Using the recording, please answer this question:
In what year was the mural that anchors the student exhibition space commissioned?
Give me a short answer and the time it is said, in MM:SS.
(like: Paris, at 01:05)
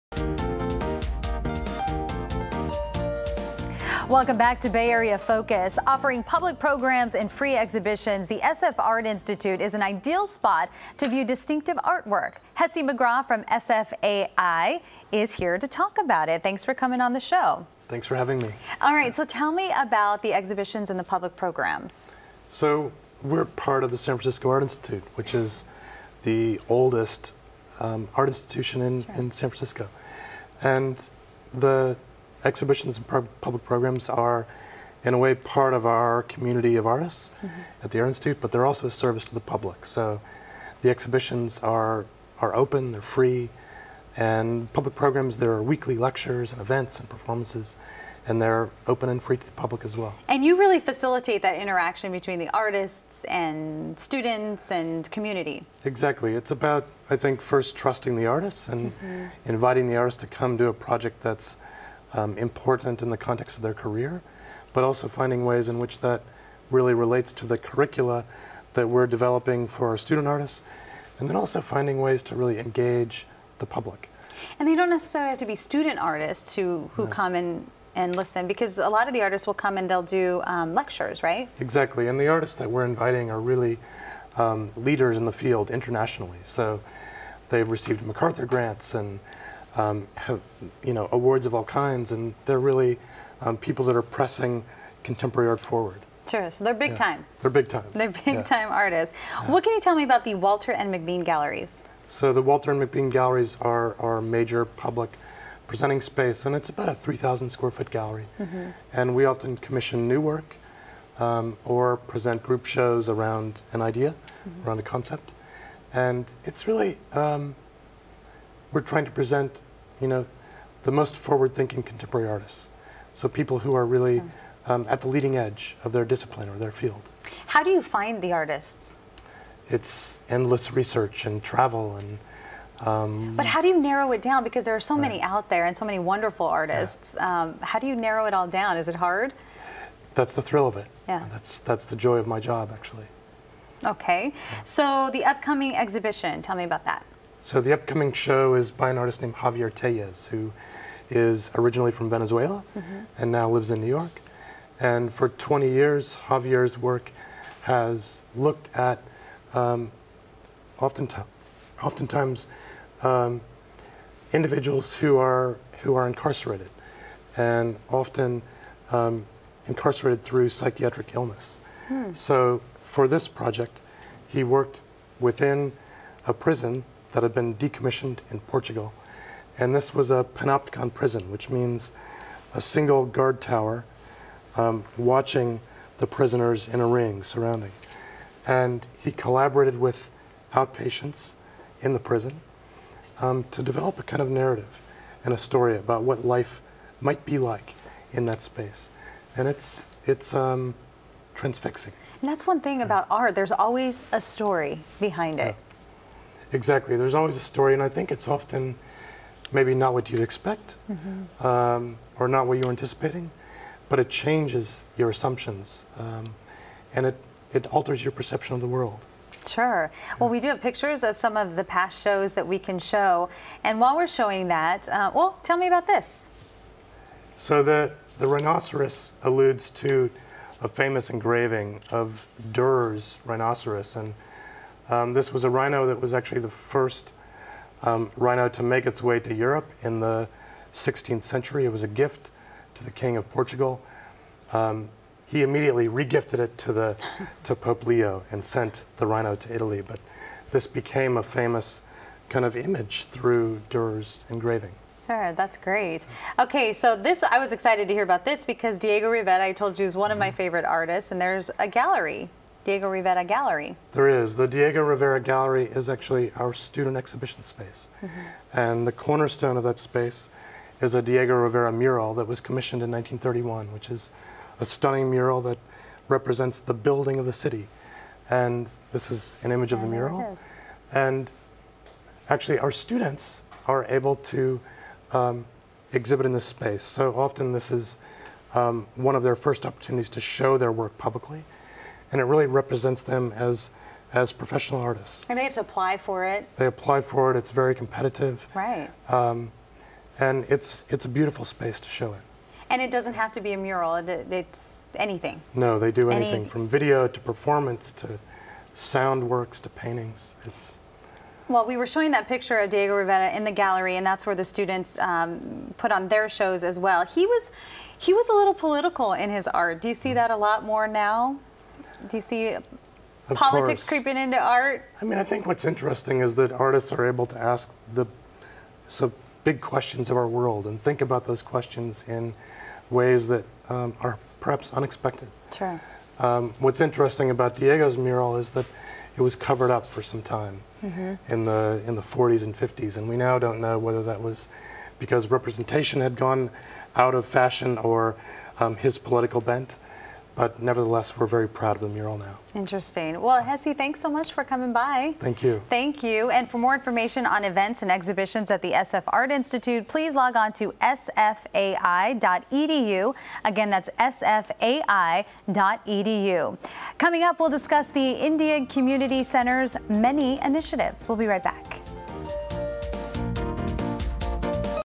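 1931, at 04:32.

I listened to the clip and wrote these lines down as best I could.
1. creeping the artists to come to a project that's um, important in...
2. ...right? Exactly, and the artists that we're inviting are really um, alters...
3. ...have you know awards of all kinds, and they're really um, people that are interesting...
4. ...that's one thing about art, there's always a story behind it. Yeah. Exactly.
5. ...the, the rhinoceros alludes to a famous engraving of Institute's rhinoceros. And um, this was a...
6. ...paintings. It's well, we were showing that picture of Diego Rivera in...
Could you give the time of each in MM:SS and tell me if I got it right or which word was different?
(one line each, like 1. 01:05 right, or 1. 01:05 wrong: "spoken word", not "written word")
1. 00:59 wrong: "inviting", not "creeping"
2. 01:21 wrong: "leaders", not "alters"
3. 01:30 wrong: "pressing", not "interesting"
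4. 03:22 right
5. 03:47 wrong: "Durer", not "Institute"
6. 05:09 right.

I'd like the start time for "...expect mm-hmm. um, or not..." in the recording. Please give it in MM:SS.
03:30.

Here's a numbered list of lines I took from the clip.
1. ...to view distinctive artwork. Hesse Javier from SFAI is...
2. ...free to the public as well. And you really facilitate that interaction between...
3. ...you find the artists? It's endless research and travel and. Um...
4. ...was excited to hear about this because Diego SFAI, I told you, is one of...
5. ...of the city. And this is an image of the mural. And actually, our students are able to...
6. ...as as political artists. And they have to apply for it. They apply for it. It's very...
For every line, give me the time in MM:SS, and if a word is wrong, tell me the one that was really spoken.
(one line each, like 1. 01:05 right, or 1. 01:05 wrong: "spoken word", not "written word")
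1. 00:10 wrong: "McGraw", not "Javier"
2. 00:49 right
3. 02:07 right
4. 04:17 wrong: "Rivera", not "SFAI"
5. 04:37 right
6. 04:53 wrong: "professional", not "political".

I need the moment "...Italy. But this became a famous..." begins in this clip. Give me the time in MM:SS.
04:09.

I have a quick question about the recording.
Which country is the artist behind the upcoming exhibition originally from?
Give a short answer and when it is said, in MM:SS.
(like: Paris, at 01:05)
Venezuela, at 02:32.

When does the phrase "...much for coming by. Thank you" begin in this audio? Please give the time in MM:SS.
05:54.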